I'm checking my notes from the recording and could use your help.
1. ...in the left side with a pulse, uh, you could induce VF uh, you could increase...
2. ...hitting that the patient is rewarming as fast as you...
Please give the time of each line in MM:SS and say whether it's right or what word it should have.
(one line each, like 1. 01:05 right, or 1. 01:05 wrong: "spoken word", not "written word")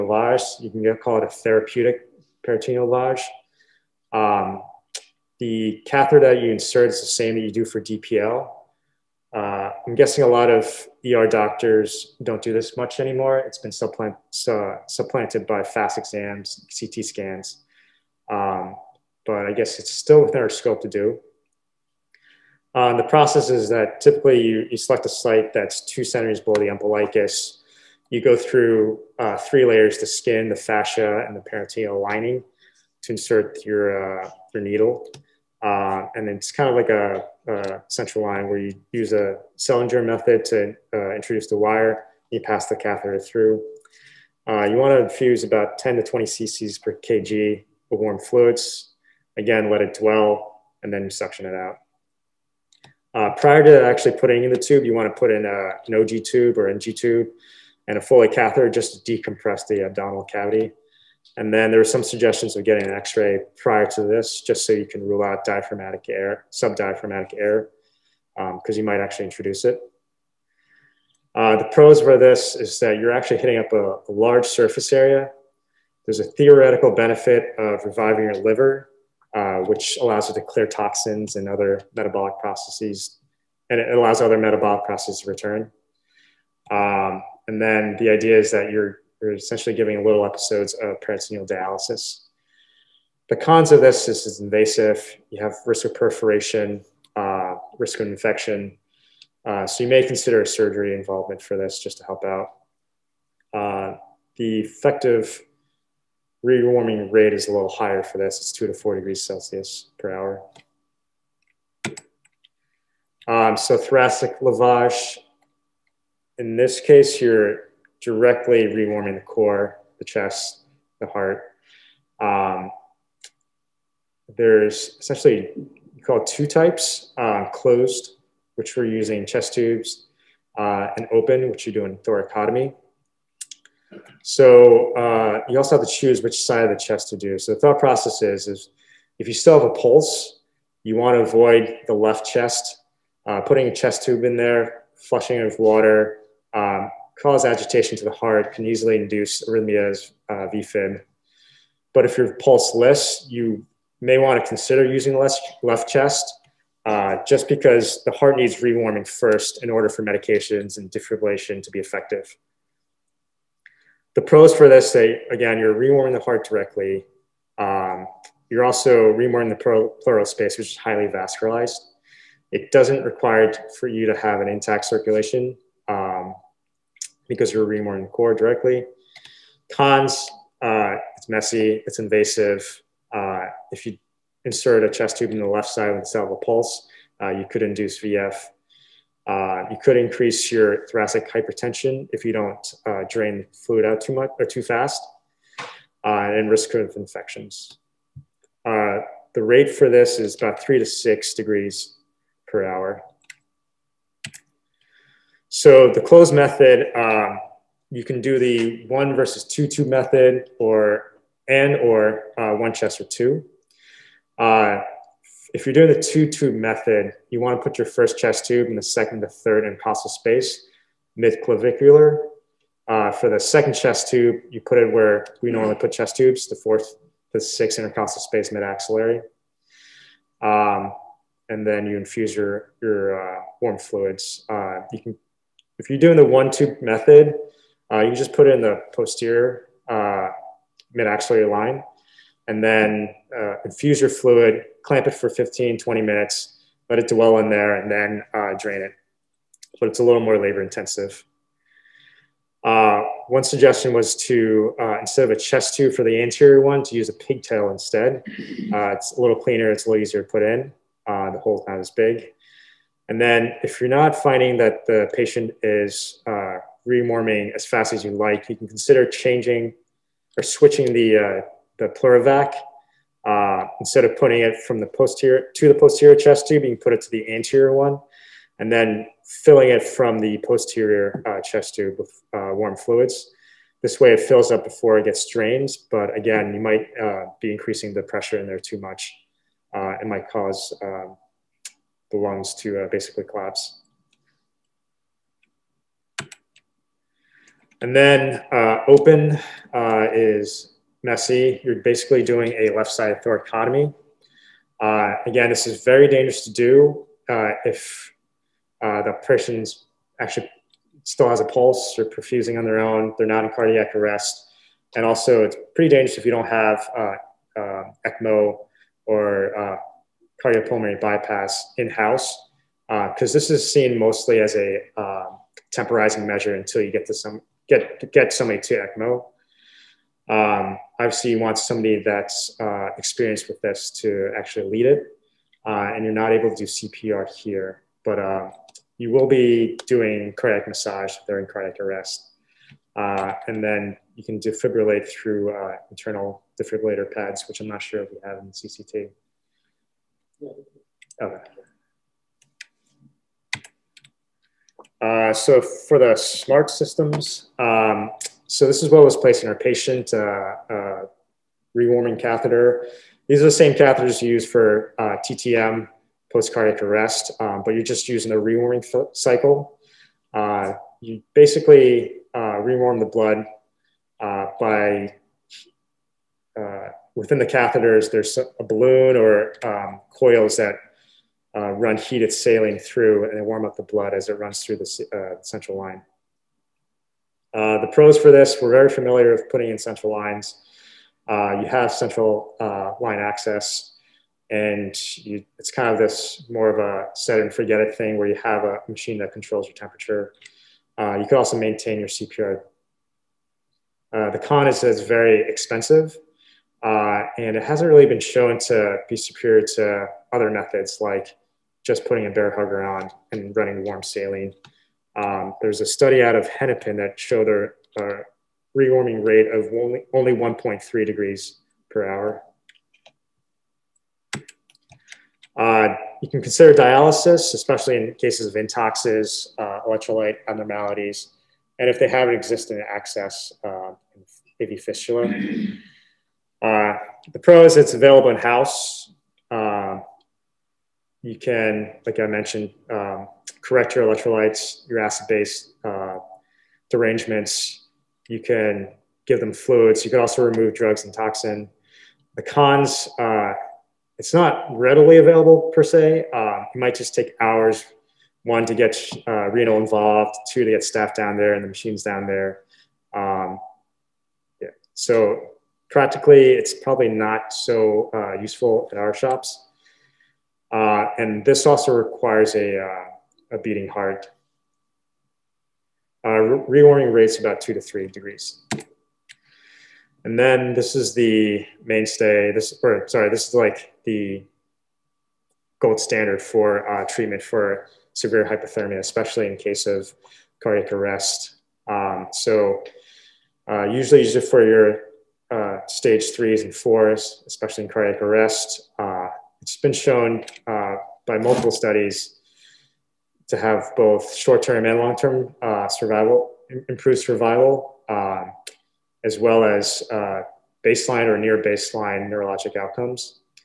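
1. 03:05 right
2. 04:24 wrong: "finding", not "hitting".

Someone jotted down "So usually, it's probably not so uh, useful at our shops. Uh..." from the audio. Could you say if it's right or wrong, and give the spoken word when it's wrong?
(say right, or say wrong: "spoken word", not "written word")
wrong: "practically", not "usually".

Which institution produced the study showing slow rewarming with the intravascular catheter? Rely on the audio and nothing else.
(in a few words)
Hennepin.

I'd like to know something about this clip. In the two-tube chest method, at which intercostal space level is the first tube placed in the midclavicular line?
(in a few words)
second to third.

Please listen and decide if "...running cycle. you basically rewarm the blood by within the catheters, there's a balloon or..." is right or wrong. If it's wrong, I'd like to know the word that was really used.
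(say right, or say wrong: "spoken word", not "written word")
wrong: "rewarming", not "running".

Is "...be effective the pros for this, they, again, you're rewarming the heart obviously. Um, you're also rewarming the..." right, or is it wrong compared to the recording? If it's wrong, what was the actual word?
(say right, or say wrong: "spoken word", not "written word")
wrong: "directly", not "obviously".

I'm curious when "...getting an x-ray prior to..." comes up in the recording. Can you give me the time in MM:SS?
01:02.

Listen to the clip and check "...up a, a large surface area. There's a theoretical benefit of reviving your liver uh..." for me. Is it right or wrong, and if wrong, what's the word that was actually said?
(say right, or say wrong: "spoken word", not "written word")
right.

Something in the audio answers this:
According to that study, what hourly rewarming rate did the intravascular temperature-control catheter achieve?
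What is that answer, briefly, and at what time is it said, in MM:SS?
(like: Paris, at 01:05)
1.3 degrees, at 07:00.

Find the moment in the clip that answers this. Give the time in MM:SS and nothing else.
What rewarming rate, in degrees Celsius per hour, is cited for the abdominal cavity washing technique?
01:48.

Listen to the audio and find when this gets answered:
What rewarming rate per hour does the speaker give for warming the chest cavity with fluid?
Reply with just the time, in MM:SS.
03:20.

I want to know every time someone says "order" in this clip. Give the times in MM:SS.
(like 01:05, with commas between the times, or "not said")
02:39.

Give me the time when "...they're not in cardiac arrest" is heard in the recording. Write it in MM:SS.
05:13.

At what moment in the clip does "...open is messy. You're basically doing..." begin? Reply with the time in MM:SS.
04:58.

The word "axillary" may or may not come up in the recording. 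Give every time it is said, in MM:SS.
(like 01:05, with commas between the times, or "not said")
03:48, 04:01.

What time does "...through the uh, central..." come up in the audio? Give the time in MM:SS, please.
06:24.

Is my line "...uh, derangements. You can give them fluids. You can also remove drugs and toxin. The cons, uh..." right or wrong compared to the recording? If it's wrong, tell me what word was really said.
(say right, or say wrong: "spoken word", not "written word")
right.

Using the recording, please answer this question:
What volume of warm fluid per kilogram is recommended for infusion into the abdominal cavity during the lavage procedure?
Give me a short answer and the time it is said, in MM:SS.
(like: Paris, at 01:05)
10 to 20 cc per kg, at 00:45.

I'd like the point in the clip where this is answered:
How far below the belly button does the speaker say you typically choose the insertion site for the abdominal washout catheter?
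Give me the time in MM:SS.
00:25.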